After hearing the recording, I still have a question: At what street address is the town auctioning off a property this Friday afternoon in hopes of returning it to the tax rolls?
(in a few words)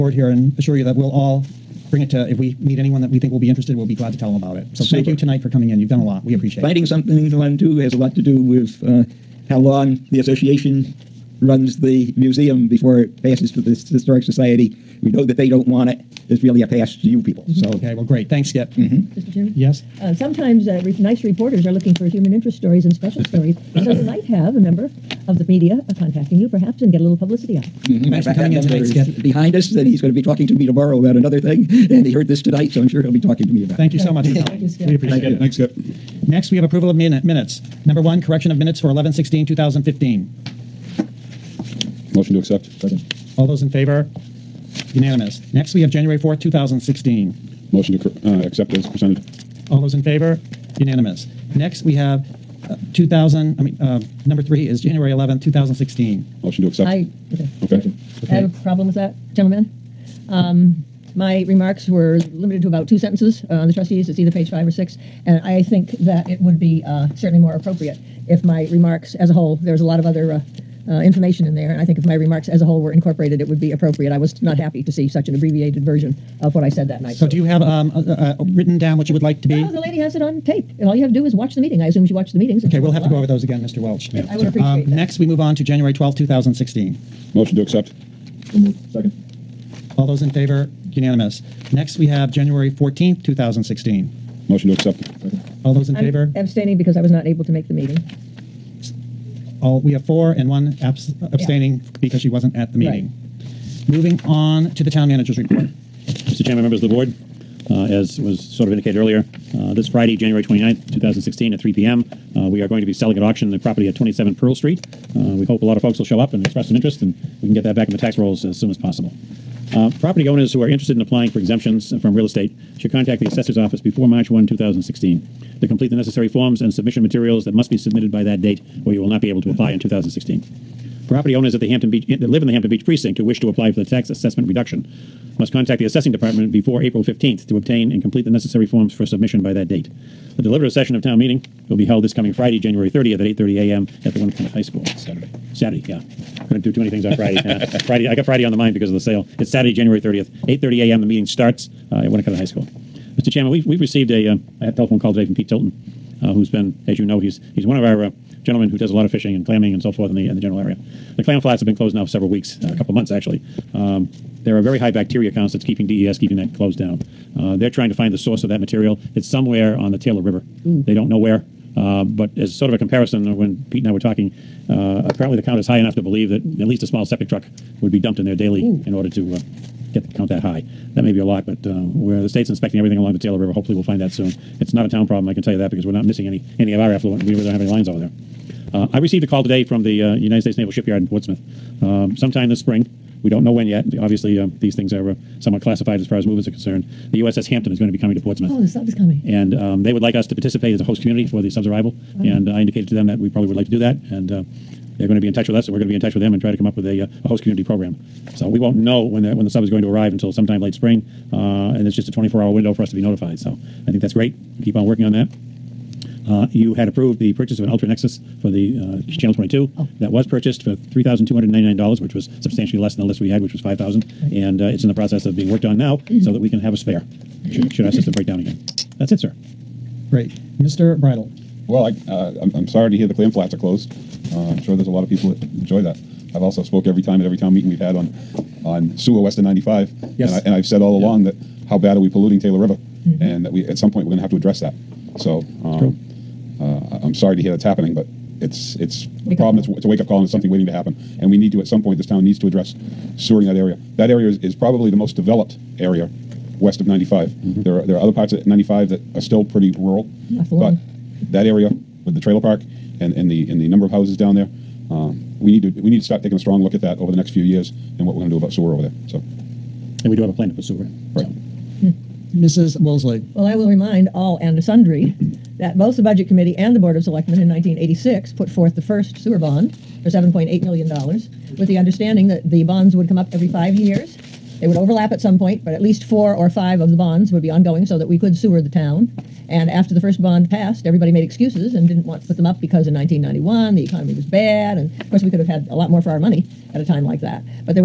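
27 Pearl Street.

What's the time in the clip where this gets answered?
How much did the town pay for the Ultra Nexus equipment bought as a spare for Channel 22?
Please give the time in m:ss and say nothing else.
3:40.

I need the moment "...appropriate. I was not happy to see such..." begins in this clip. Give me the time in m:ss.
1:13.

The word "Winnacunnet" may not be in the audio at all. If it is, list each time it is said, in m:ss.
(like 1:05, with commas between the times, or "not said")
2:24, 2:32.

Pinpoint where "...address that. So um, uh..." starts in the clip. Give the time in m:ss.
4:04.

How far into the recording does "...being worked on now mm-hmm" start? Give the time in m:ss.
3:45.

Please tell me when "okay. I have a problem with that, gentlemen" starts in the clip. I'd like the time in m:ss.
0:58.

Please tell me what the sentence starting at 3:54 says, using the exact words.
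Uh, I'm sure there's a lot of people that enjoy that.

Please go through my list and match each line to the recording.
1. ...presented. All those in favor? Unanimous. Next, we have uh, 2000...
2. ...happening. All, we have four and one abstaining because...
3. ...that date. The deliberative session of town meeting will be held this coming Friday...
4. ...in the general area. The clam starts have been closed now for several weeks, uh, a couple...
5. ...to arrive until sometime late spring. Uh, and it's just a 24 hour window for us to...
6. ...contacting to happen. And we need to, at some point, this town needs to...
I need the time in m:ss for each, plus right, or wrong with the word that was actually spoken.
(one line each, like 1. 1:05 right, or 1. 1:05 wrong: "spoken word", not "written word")
1. 0:48 right
2. 1:37 wrong: "meeting", not "happening"
3. 2:19 right
4. 2:40 wrong: "flats", not "starts"
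5. 3:29 right
6. 4:10 wrong: "waiting", not "contacting".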